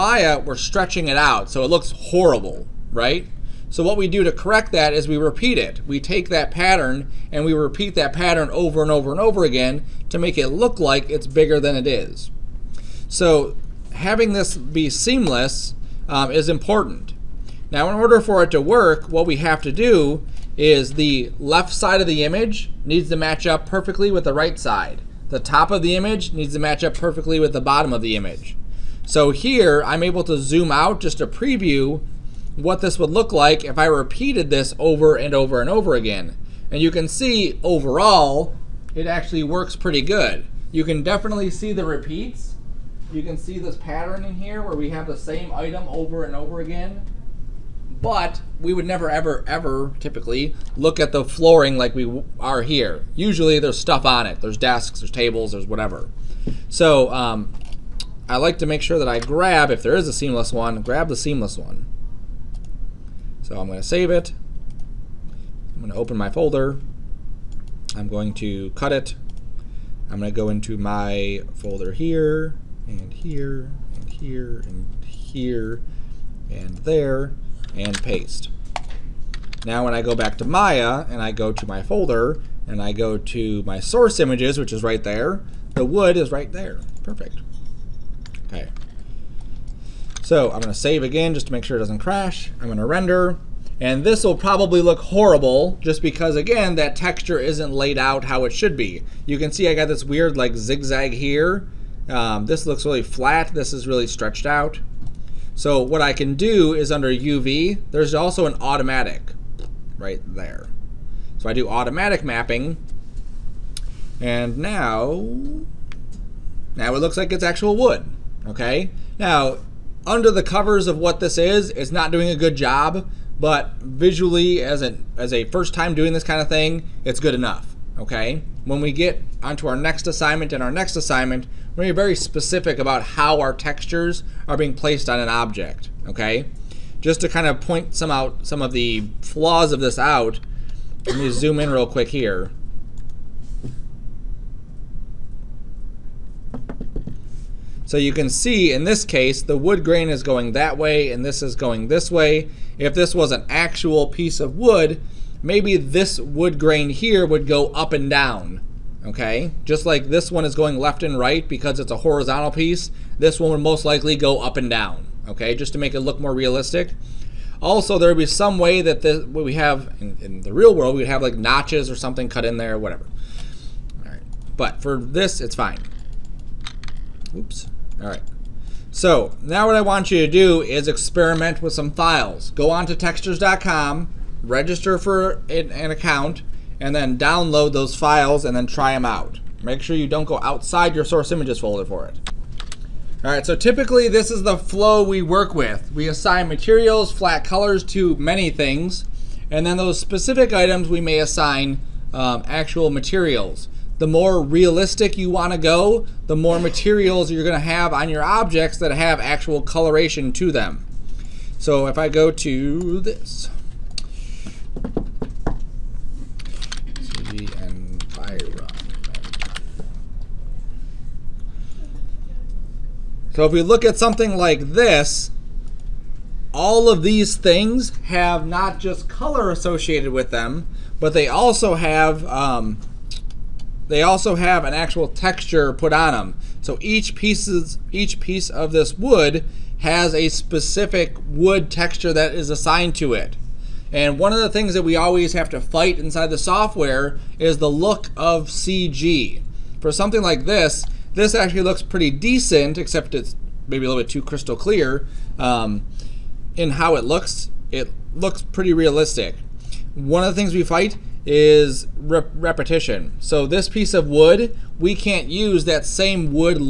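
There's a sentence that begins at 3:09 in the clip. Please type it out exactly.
Make sure you don't go outside your source images folder for it.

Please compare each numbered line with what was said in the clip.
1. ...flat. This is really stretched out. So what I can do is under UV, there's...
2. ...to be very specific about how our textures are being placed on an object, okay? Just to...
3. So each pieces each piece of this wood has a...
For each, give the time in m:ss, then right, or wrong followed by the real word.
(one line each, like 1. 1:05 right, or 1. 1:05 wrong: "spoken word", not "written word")
1. 1:43 right
2. 2:11 right
3. 3:56 right.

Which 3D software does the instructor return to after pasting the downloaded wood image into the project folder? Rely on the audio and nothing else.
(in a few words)
Maya.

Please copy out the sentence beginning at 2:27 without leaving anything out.
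So you can see in this case, the wood grain is going that way and this is going this way.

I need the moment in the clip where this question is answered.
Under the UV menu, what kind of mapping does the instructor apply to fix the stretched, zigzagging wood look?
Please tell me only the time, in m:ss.
1:51.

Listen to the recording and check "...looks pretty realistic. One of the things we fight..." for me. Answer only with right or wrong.
right.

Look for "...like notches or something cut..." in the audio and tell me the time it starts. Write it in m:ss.
2:51.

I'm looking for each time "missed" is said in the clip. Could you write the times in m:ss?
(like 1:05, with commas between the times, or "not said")
not said.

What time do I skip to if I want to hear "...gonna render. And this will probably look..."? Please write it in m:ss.
1:32.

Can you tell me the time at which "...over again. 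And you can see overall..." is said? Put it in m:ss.
0:35.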